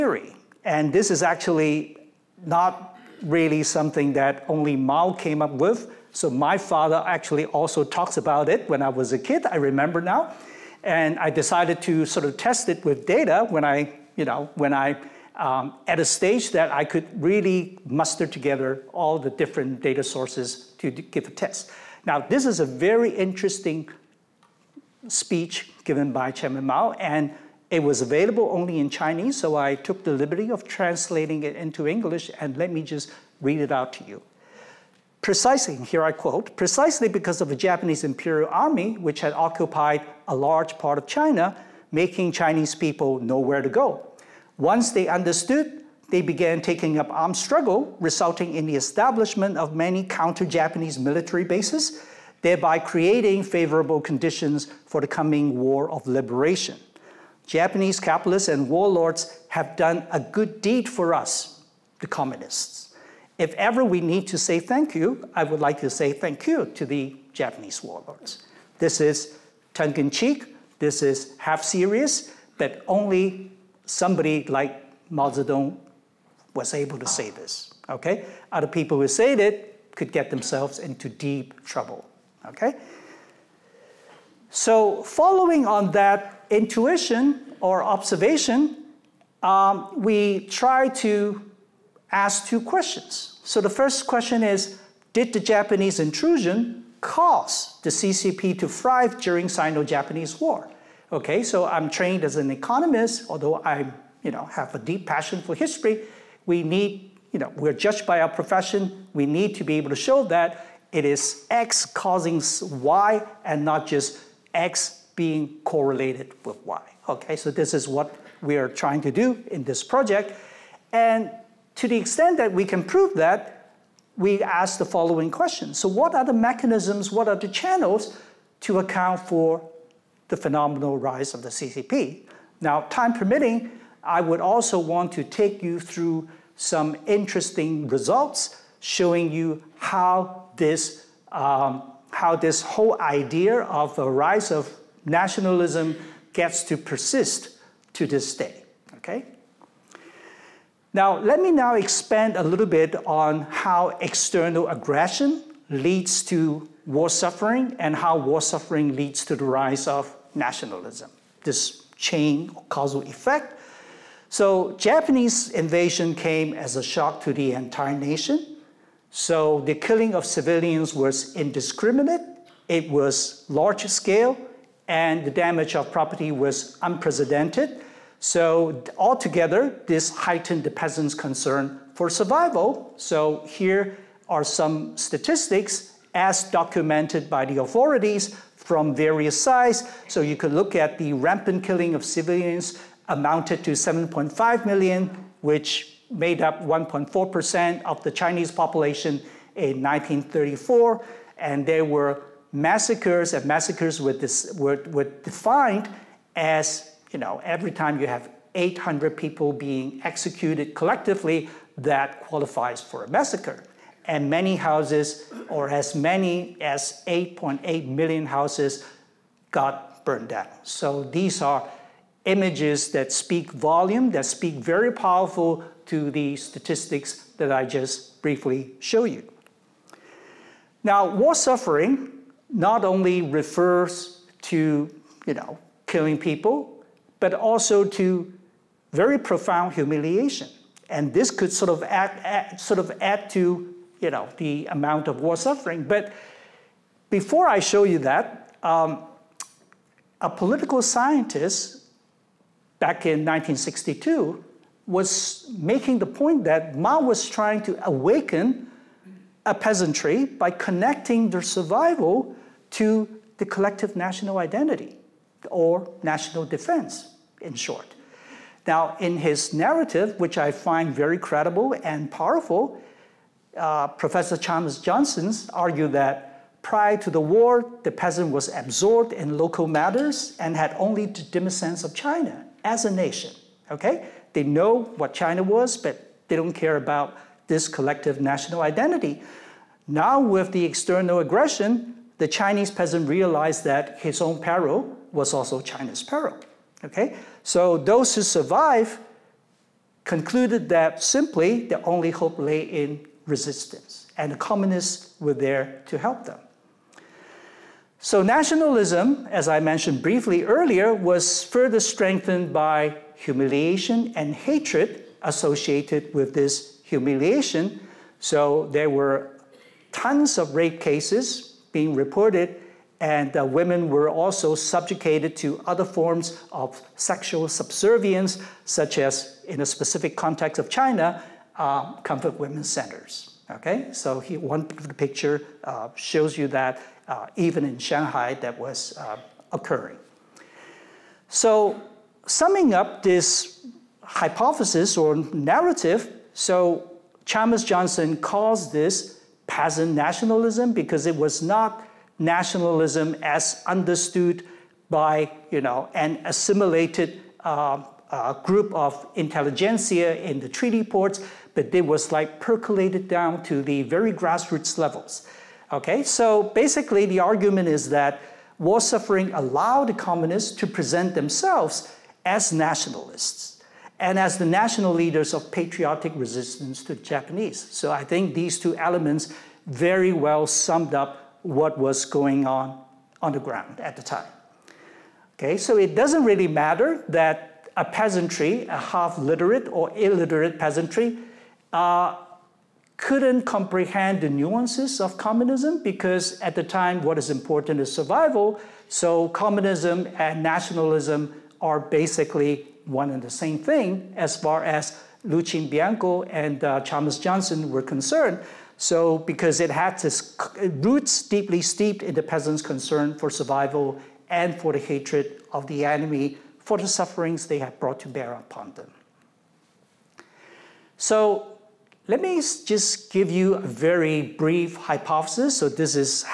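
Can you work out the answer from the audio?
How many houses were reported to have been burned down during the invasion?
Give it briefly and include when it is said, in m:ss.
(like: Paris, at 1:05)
8.8 million, at 3:37.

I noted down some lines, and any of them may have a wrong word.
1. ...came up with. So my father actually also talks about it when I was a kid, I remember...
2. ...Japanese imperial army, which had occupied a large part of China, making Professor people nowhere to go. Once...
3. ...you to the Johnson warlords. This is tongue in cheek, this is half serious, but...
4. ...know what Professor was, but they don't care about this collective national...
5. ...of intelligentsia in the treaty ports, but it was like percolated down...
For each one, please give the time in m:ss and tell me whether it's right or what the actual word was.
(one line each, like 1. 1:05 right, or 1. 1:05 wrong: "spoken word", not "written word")
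1. 0:05 right
2. 0:37 wrong: "Chinese", not "Professor"
3. 1:06 wrong: "Japanese", not "Johnson"
4. 4:44 wrong: "China", not "Professor"
5. 5:58 right.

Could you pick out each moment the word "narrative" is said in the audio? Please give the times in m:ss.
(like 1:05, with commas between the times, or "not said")
4:29, 5:45.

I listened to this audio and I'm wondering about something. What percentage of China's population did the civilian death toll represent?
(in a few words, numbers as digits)
1.4%.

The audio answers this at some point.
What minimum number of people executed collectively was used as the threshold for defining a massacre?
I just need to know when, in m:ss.
3:28.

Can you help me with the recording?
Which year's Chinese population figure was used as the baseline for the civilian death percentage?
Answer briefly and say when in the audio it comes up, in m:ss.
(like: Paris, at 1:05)
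1934, at 3:19.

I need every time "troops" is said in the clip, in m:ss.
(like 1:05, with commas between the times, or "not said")
not said.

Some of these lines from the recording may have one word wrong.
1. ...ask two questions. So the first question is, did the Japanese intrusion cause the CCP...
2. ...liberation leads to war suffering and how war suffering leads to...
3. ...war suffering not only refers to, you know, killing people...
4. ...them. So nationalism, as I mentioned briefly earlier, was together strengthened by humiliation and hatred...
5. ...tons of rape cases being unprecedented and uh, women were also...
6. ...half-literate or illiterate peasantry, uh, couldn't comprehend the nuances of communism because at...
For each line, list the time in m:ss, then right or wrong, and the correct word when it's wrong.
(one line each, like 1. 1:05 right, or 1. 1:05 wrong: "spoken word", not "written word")
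1. 1:32 right
2. 2:34 wrong: "aggression", not "liberation"
3. 3:51 right
4. 5:06 wrong: "further", not "together"
5. 5:19 wrong: "reported", not "unprecedented"
6. 6:28 right.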